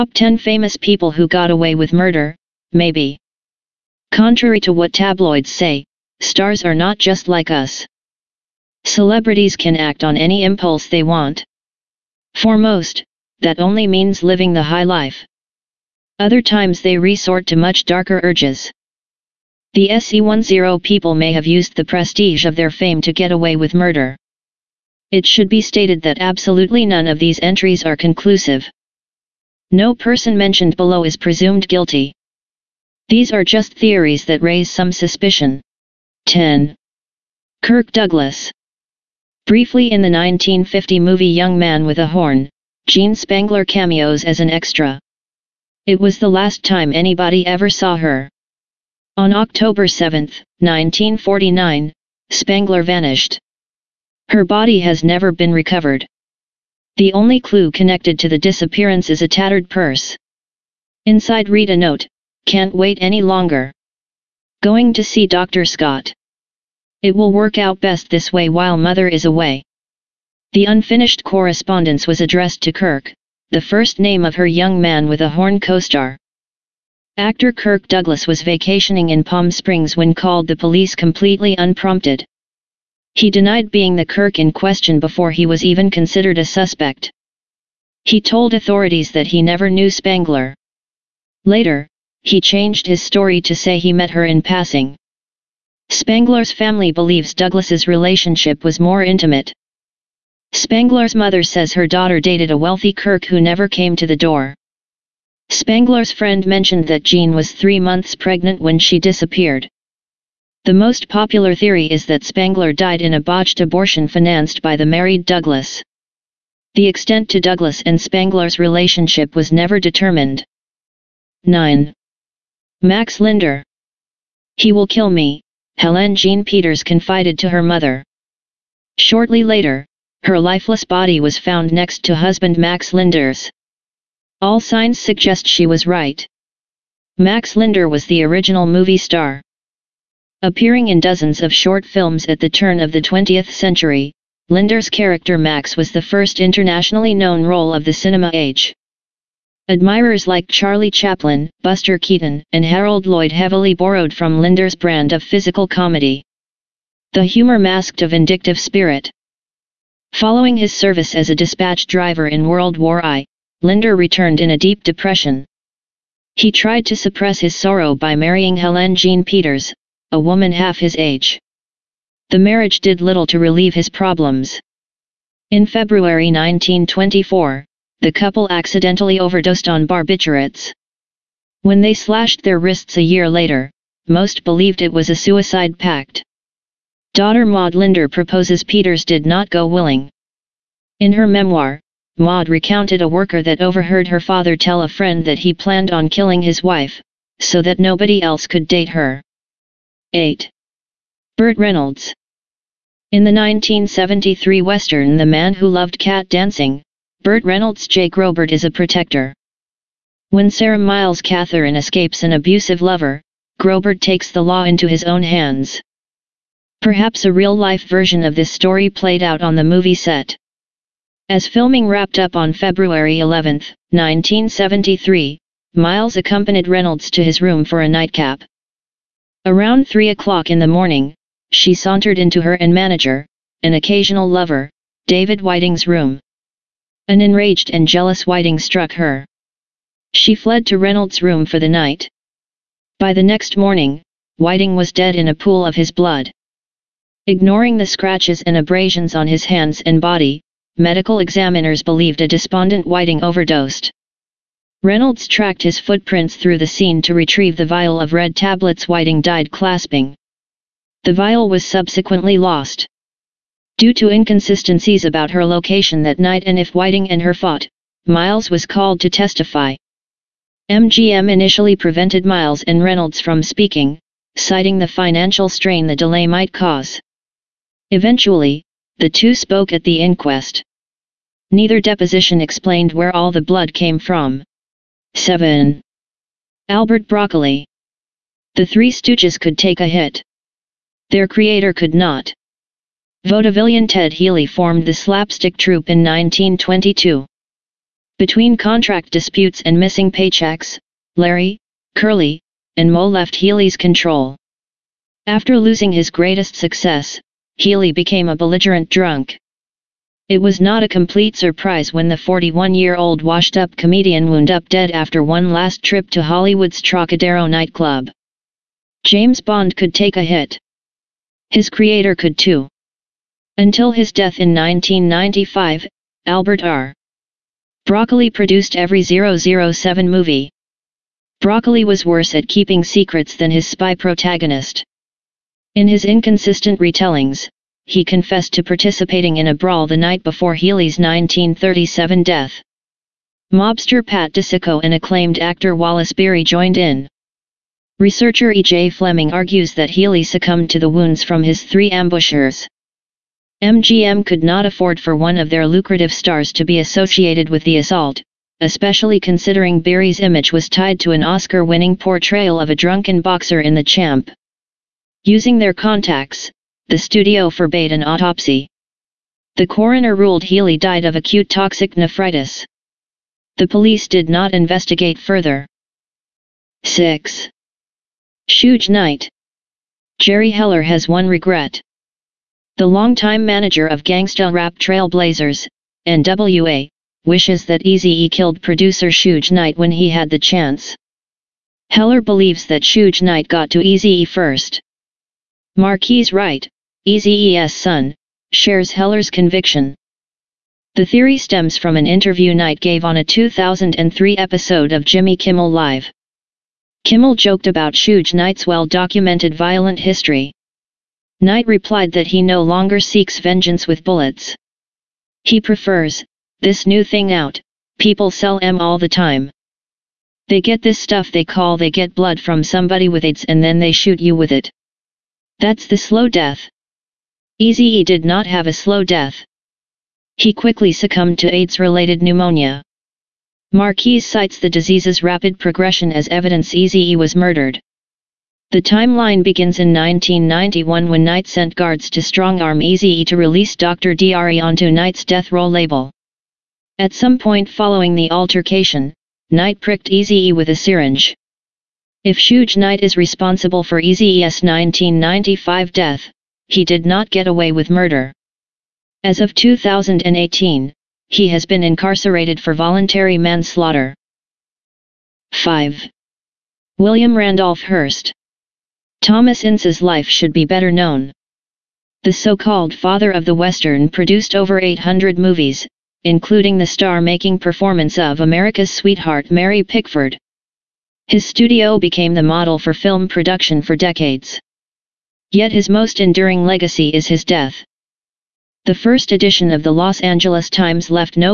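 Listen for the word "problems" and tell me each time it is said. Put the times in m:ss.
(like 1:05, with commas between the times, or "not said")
2:53.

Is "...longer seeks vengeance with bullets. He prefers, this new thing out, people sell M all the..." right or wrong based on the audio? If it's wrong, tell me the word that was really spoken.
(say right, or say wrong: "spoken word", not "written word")
right.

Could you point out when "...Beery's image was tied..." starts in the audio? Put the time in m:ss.
5:59.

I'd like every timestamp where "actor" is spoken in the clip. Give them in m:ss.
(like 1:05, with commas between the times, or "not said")
1:17, 5:45.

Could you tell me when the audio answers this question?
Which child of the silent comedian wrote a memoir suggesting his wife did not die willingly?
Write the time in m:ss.
3:07.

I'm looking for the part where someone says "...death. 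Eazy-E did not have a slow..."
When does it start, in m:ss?
7:06.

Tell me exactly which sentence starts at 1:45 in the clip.
Spangler's friend mentioned that Jean was three months pregnant when she disappeared.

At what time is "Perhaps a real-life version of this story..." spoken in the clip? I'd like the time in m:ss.
3:36.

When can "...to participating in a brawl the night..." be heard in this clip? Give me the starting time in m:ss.
5:38.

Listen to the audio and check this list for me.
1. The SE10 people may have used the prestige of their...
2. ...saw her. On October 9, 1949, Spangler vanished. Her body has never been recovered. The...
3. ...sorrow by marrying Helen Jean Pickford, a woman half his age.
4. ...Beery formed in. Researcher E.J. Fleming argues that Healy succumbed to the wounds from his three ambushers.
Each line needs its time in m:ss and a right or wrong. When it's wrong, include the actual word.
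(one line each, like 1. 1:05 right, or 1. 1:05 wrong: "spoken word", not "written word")
1. 0:19 right
2. 0:47 wrong: "7", not "9"
3. 2:47 wrong: "Peters", not "Pickford"
4. 5:46 wrong: "joined", not "formed".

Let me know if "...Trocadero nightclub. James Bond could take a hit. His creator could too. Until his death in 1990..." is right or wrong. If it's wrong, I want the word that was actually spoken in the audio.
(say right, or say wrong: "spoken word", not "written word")
wrong: "1995", not "1990".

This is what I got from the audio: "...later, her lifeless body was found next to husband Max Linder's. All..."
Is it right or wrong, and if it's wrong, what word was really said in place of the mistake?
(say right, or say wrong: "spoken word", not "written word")
right.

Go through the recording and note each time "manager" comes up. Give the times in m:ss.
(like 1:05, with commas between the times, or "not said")
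3:52, 6:23.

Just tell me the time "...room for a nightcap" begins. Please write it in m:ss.
3:47.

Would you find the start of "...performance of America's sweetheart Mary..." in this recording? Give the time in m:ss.
7:57.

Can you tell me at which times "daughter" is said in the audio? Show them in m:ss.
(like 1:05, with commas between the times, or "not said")
1:41, 3:07.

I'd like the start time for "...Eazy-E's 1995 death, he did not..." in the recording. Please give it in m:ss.
7:34.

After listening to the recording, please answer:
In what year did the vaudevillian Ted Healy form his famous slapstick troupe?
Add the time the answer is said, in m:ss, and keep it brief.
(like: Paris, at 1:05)
1922, at 4:55.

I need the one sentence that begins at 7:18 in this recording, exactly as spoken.
The timeline begins in 1991 when Knight sent guards to strong-arm Eazy-E to release Dr.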